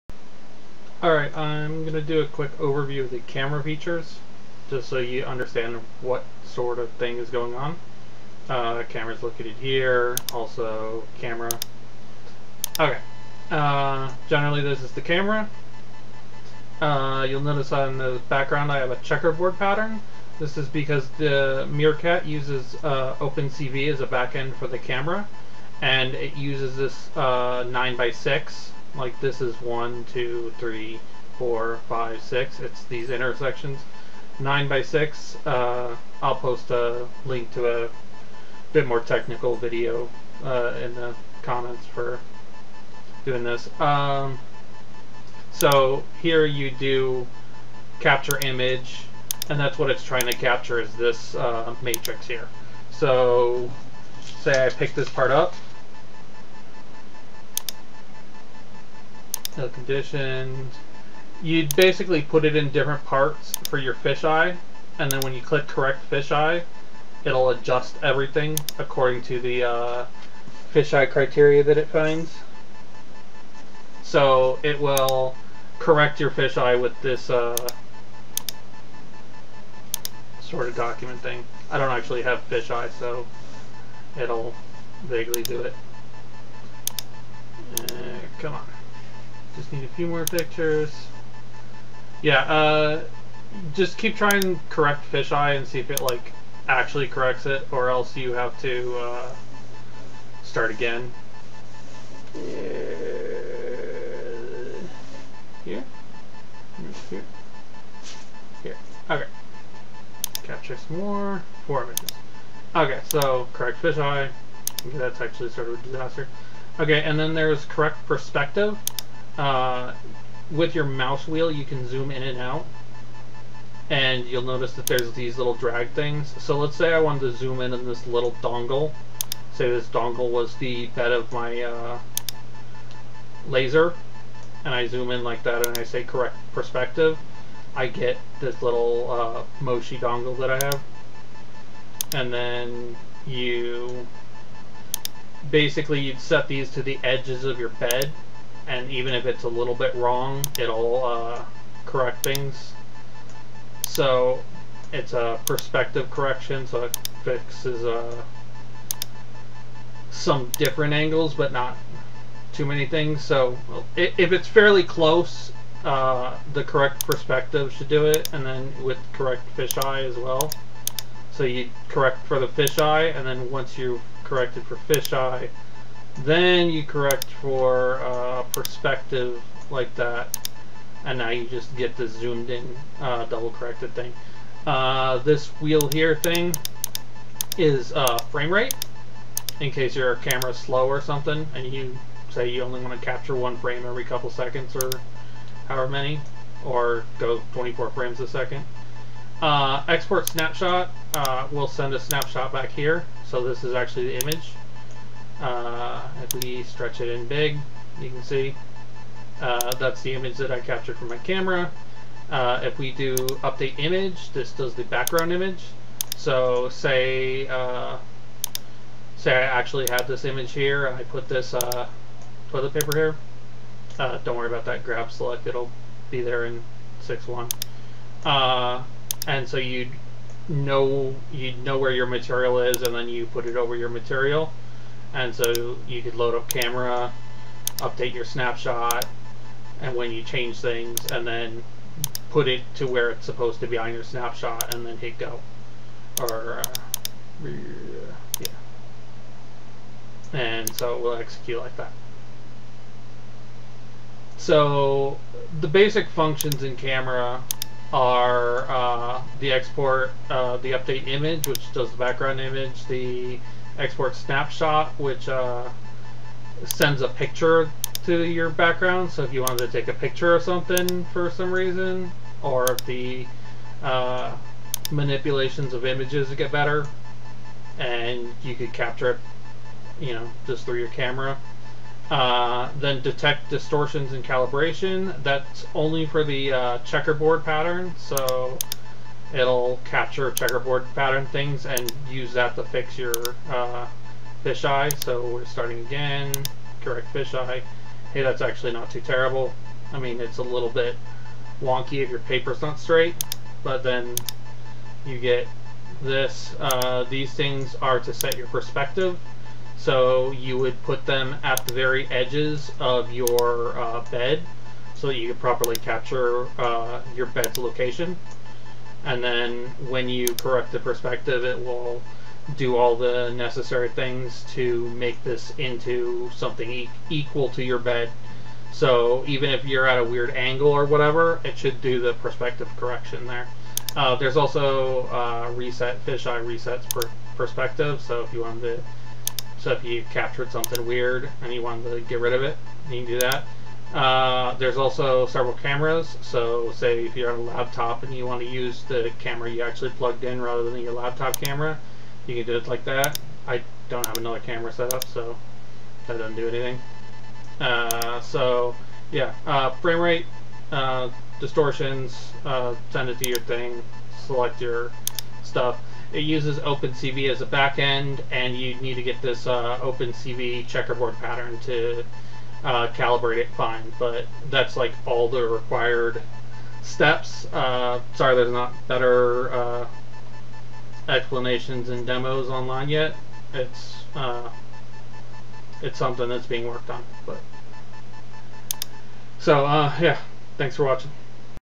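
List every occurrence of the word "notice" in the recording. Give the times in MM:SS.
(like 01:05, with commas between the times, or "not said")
00:17, 02:04.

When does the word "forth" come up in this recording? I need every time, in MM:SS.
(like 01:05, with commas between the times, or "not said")
not said.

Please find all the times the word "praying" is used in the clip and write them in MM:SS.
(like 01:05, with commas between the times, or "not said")
not said.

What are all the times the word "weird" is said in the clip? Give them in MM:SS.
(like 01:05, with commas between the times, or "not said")
05:30, 05:40.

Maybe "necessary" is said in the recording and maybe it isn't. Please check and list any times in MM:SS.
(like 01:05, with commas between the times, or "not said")
05:23.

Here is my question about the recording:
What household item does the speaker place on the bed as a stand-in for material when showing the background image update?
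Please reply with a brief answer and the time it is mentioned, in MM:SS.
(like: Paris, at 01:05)
toilet paper, at 03:42.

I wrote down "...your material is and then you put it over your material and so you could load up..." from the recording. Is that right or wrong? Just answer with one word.
right.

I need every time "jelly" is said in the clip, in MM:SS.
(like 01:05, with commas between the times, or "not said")
not said.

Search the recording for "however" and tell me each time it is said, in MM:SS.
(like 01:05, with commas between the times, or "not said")
03:15.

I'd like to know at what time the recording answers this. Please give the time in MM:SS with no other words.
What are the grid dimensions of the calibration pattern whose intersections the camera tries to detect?
00:27.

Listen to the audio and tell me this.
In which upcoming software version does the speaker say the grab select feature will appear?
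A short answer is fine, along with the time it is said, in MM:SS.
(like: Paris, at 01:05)
6.1, at 03:47.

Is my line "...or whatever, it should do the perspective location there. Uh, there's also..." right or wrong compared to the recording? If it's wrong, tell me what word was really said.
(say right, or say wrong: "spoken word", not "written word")
wrong: "correction", not "location".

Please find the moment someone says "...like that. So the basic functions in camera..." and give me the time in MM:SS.
04:11.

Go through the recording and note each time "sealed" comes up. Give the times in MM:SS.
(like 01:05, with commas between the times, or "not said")
not said.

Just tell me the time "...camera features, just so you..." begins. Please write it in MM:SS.
00:03.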